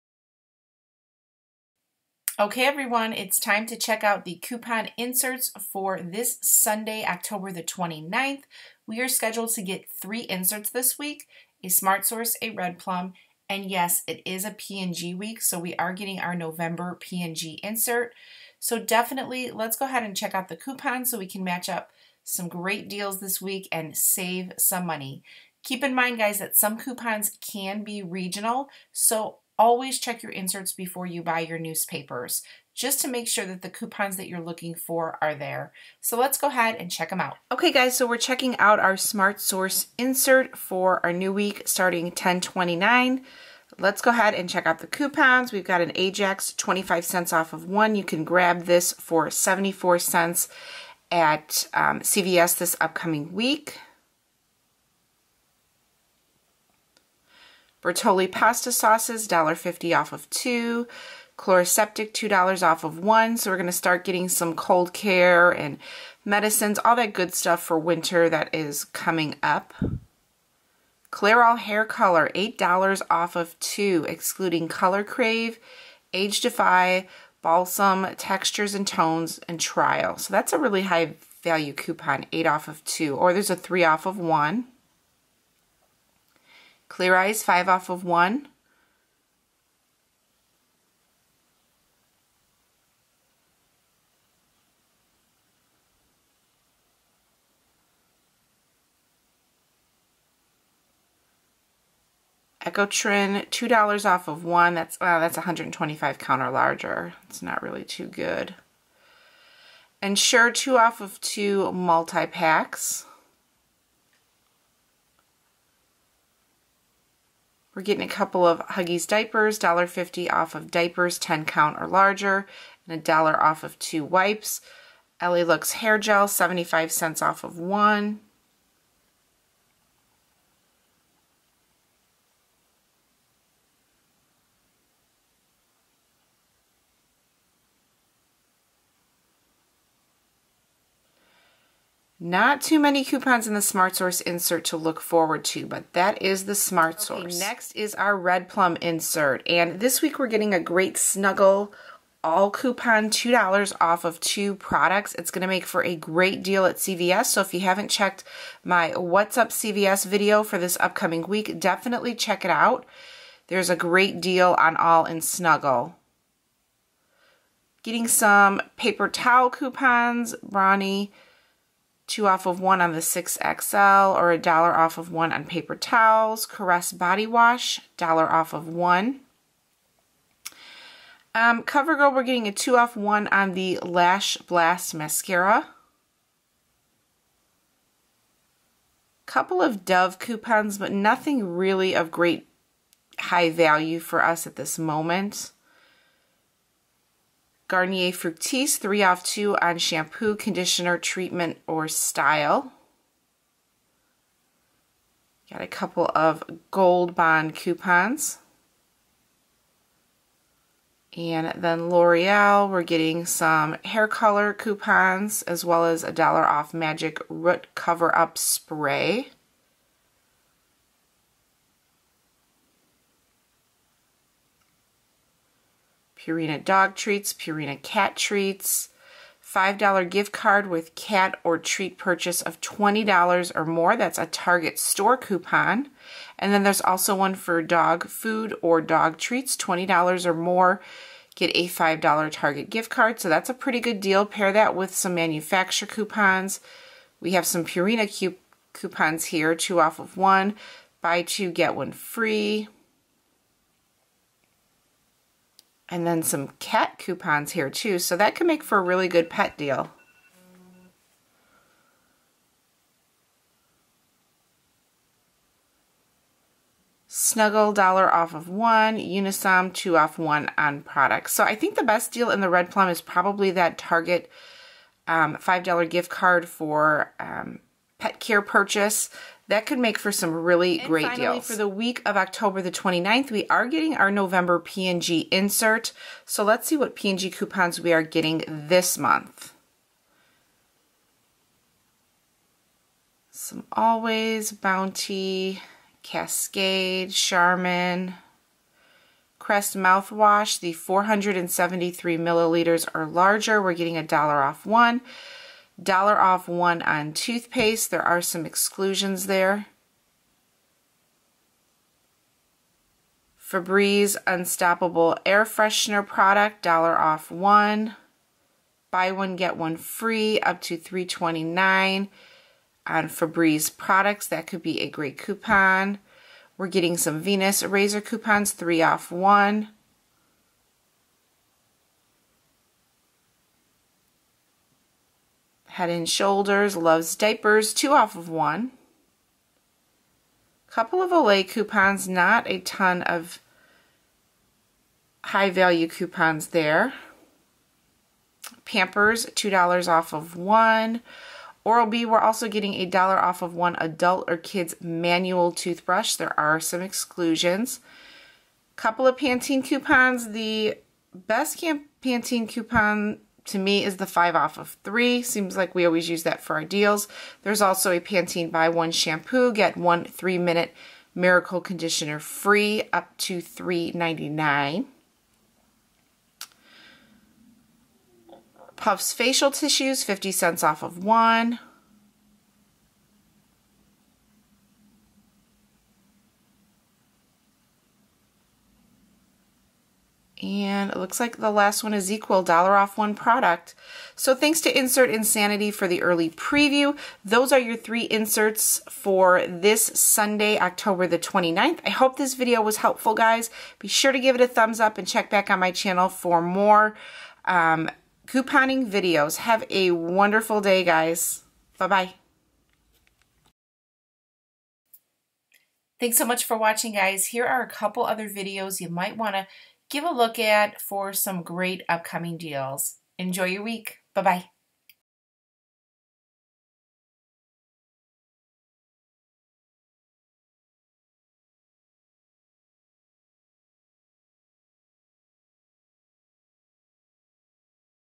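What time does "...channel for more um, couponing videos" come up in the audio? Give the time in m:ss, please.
6:45.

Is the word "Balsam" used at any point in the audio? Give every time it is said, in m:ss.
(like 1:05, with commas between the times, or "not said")
1:17.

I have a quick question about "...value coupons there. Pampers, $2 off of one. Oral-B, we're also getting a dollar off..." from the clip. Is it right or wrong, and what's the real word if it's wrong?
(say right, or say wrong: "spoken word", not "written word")
right.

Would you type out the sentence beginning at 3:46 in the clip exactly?
Purina dog treats, Purina cat treats, $5 gift card with cat or treat purchase of $20 or more.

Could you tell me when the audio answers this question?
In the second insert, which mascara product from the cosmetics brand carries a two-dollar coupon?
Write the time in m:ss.
3:03.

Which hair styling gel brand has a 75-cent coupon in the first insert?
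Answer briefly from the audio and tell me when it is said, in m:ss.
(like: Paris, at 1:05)
L.A. Looks, at 2:05.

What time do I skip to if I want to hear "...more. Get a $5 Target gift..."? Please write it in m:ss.
4:00.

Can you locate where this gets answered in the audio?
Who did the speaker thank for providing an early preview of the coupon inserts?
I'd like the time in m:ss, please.
6:34.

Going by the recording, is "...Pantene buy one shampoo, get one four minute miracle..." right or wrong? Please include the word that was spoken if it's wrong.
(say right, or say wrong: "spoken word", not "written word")
wrong: "three", not "four".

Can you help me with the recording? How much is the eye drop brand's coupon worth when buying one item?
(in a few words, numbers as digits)
5 off of 1.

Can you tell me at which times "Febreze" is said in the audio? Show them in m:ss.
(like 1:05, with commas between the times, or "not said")
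5:13, 5:23.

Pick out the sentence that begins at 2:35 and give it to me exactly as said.
It's going to make for a great deal at CVS.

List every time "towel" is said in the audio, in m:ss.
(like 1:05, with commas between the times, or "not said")
2:49, 2:55.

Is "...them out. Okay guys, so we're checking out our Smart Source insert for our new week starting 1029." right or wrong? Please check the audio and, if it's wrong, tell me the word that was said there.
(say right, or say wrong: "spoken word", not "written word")
right.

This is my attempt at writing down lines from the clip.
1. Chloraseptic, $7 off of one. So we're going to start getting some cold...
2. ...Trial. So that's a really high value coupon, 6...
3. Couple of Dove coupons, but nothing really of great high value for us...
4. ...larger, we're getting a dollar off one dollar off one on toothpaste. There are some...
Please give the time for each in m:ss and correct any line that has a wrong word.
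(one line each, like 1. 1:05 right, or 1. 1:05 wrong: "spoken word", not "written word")
1. 1:01 wrong: "2", not "7"
2. 1:19 wrong: "8", not "6"
3. 3:09 right
4. 5:03 right.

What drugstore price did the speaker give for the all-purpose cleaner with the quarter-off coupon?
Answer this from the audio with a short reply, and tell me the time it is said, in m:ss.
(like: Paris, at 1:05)
74 cents, at 0:49.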